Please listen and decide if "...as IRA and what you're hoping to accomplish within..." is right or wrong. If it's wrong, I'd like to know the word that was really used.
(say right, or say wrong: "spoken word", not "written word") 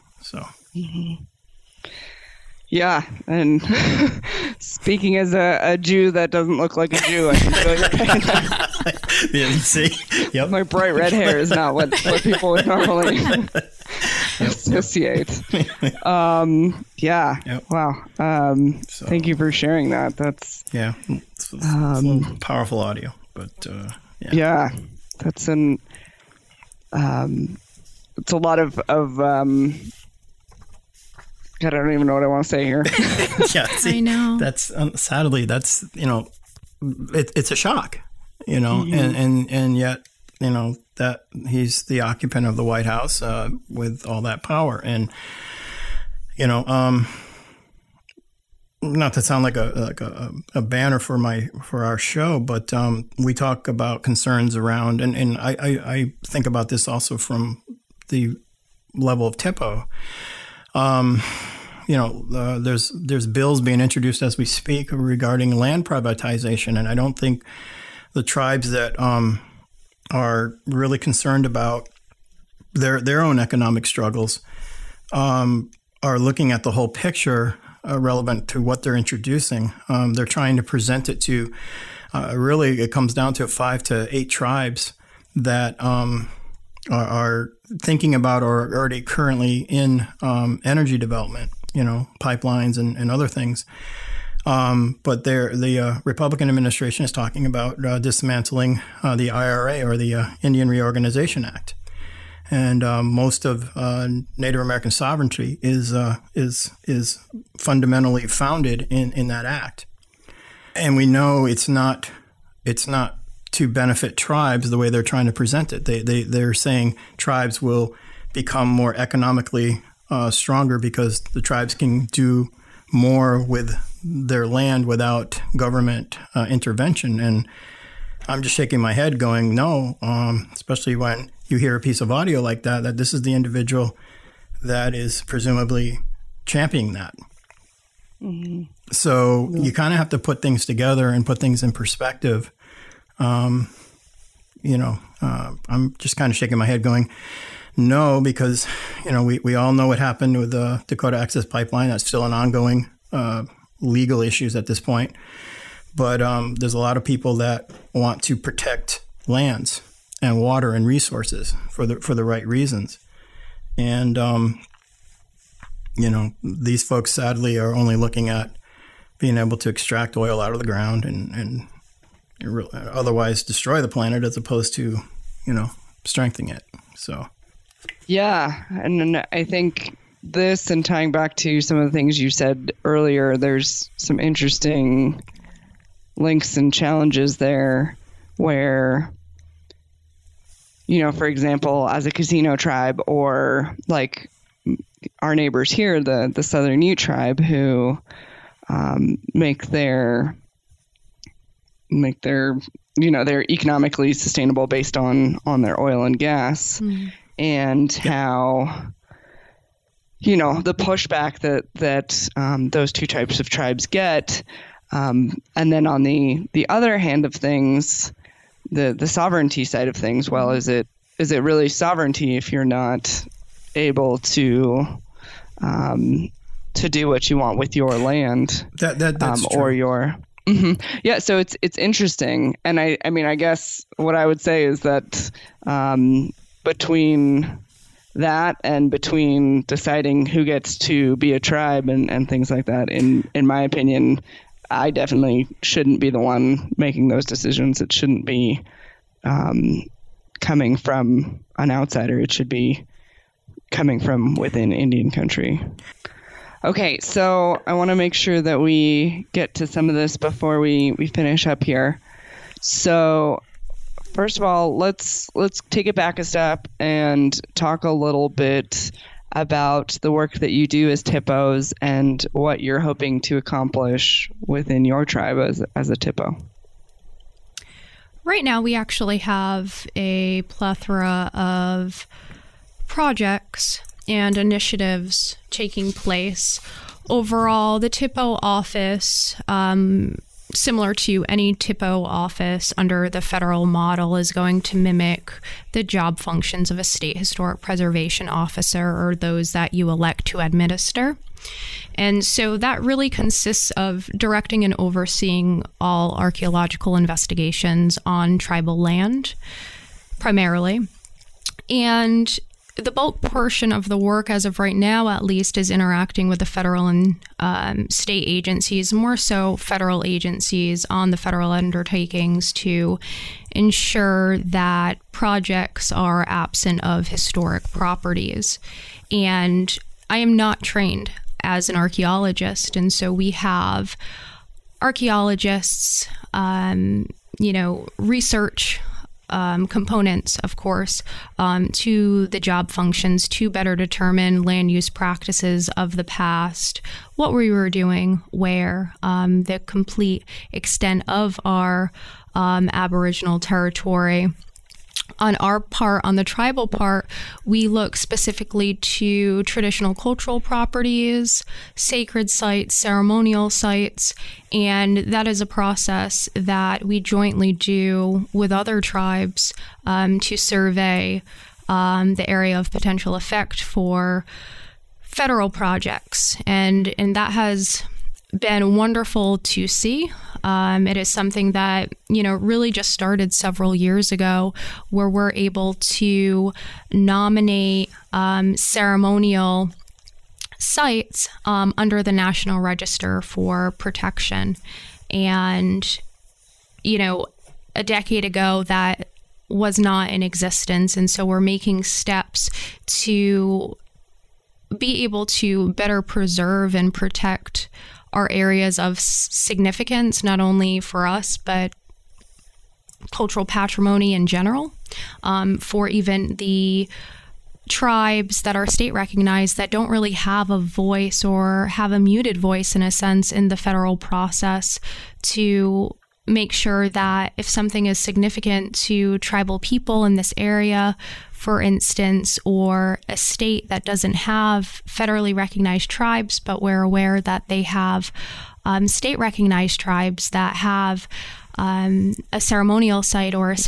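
wrong: "THPOs", not "IRA".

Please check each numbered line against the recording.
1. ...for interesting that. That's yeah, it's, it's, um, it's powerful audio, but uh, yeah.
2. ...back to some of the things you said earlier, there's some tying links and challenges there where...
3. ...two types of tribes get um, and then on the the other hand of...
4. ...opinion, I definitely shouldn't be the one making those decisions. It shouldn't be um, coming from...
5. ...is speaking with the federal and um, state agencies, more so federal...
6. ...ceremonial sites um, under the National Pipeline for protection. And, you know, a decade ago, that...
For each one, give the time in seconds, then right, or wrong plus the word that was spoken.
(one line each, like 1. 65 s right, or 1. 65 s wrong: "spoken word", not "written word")
1. 19 s wrong: "sharing", not "interesting"
2. 181 s wrong: "interesting", not "tying"
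3. 212 s right
4. 243 s right
5. 315 s wrong: "interacting", not "speaking"
6. 388 s wrong: "Register", not "Pipeline".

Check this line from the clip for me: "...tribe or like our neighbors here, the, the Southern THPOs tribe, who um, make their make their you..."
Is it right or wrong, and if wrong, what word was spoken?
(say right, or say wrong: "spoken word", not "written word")
wrong: "Ute", not "THPOs".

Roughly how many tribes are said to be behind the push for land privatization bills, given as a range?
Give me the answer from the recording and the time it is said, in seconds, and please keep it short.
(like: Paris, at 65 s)
5 to 8, at 83 s.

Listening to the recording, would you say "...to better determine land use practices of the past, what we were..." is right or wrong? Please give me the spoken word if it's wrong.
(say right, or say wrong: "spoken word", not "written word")
right.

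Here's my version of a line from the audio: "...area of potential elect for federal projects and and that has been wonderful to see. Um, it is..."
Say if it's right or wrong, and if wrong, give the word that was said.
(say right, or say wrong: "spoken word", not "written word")
wrong: "effect", not "elect".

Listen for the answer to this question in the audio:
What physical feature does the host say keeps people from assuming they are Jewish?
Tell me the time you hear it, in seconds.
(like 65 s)
10 s.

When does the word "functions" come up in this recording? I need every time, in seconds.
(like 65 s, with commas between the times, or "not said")
296 s, 342 s.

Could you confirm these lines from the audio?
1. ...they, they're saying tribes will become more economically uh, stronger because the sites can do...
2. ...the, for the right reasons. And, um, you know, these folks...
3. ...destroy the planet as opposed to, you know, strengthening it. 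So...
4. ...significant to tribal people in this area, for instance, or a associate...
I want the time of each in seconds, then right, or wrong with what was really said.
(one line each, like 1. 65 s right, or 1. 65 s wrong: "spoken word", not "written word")
1. 116 s wrong: "tribes", not "sites"
2. 161 s right
3. 173 s right
4. 427 s wrong: "state", not "associate".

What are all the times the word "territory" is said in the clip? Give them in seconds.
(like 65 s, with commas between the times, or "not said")
353 s.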